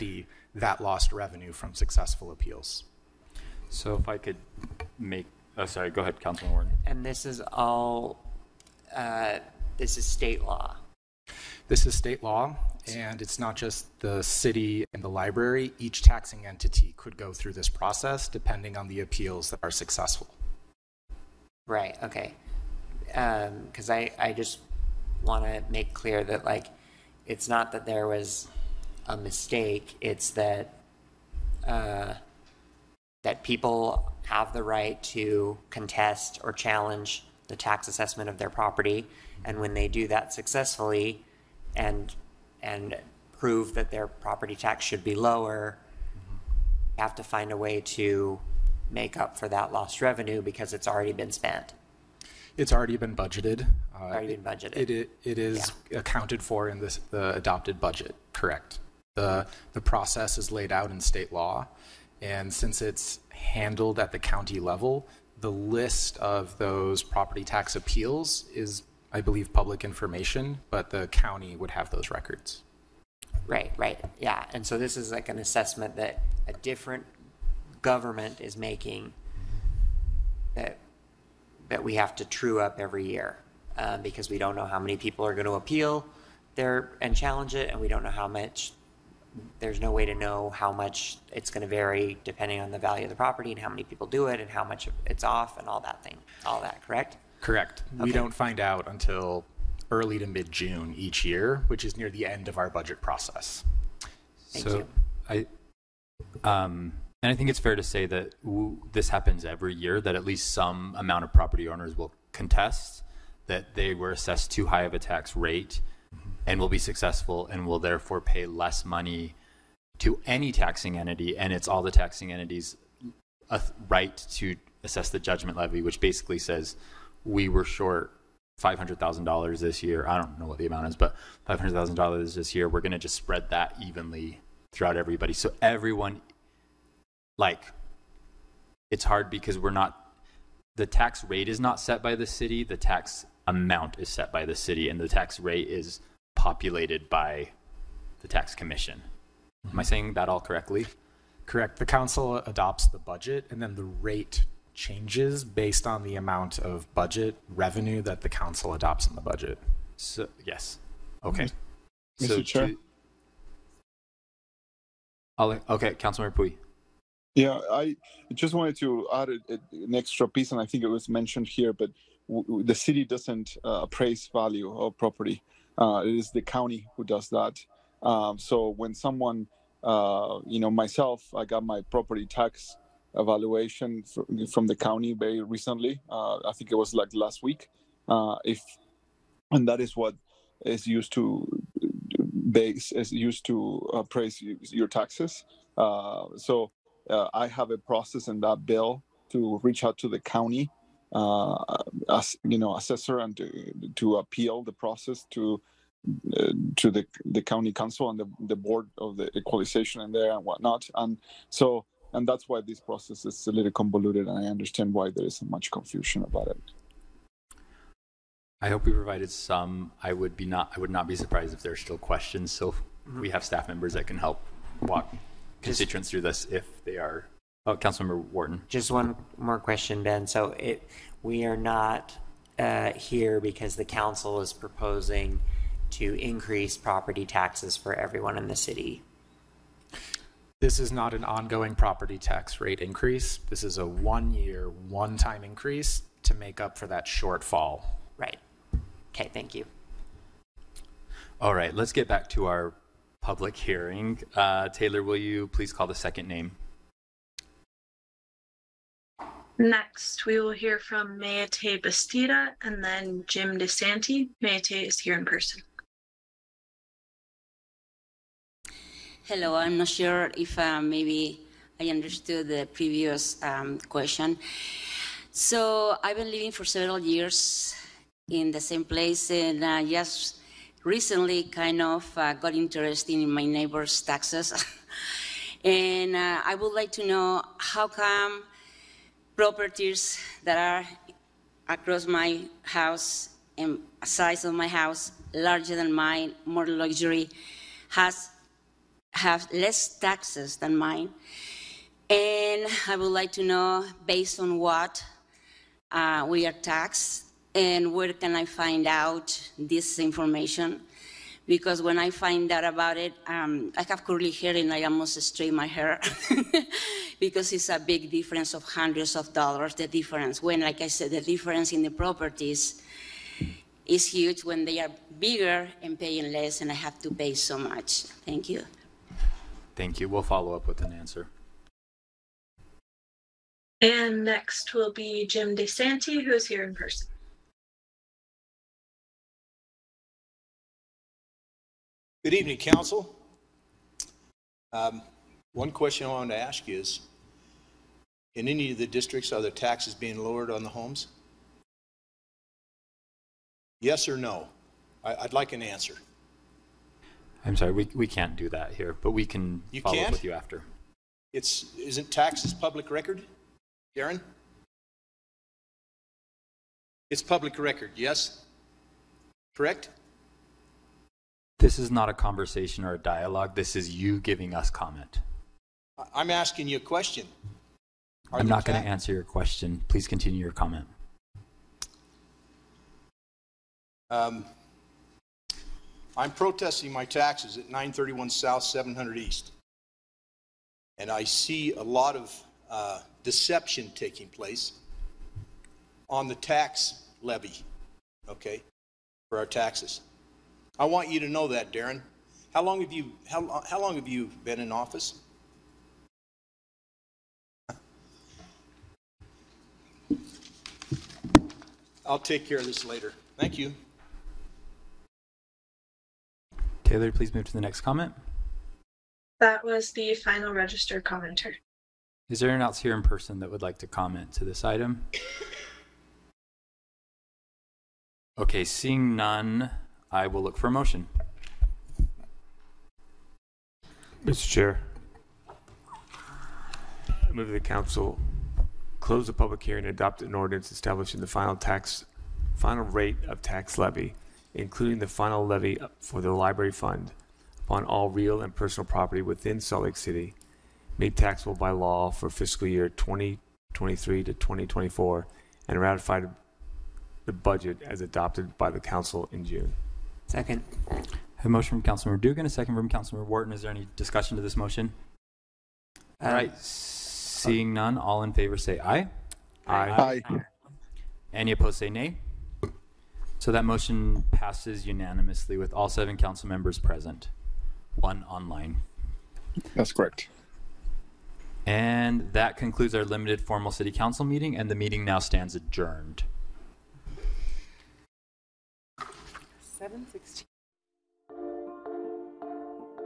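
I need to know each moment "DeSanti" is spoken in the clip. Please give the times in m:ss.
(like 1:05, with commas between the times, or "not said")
4:23, 5:35.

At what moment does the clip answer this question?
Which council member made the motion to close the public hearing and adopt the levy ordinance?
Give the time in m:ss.
7:42.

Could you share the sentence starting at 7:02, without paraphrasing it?
Is there anyone else here in person that would like to comment to this item?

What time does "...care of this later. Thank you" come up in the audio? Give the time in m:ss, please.
6:52.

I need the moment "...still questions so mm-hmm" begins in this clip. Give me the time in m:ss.
3:41.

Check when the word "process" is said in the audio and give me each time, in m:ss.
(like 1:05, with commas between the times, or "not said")
0:17, 0:59, 1:43, 3:17, 3:24, 3:32.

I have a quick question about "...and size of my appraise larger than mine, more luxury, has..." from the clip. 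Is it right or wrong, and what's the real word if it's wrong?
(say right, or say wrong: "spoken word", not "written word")
wrong: "house", not "appraise".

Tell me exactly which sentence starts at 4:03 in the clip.
This is a one-year, one-time increase to make up for that shortfall.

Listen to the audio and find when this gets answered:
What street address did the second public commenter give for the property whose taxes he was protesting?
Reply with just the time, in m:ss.
6:27.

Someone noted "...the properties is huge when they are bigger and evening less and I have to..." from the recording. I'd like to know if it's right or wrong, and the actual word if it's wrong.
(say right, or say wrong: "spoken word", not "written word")
wrong: "paying", not "evening".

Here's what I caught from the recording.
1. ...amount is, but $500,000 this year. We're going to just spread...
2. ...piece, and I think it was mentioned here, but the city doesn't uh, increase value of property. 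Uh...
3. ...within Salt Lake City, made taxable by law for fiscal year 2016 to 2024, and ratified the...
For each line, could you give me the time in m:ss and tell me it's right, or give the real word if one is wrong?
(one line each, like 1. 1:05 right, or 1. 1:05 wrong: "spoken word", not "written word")
1. 2:10 right
2. 2:50 wrong: "appraise", not "increase"
3. 7:29 wrong: "2023", not "2016".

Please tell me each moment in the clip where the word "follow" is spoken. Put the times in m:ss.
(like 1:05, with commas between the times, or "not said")
5:30, 5:59.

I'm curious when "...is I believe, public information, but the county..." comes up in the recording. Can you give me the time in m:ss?
1:08.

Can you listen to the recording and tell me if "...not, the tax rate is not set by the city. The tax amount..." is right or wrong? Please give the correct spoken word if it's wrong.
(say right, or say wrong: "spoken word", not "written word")
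right.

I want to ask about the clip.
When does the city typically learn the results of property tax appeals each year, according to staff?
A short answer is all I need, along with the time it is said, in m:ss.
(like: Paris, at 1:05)
Early to mid June, at 1:39.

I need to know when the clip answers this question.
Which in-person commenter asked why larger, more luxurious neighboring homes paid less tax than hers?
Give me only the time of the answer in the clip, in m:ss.
4:21.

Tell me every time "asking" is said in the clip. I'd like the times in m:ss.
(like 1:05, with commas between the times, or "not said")
6:16.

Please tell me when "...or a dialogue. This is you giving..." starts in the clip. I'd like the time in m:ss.
6:12.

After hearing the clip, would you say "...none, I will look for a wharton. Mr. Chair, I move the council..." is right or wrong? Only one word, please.
wrong.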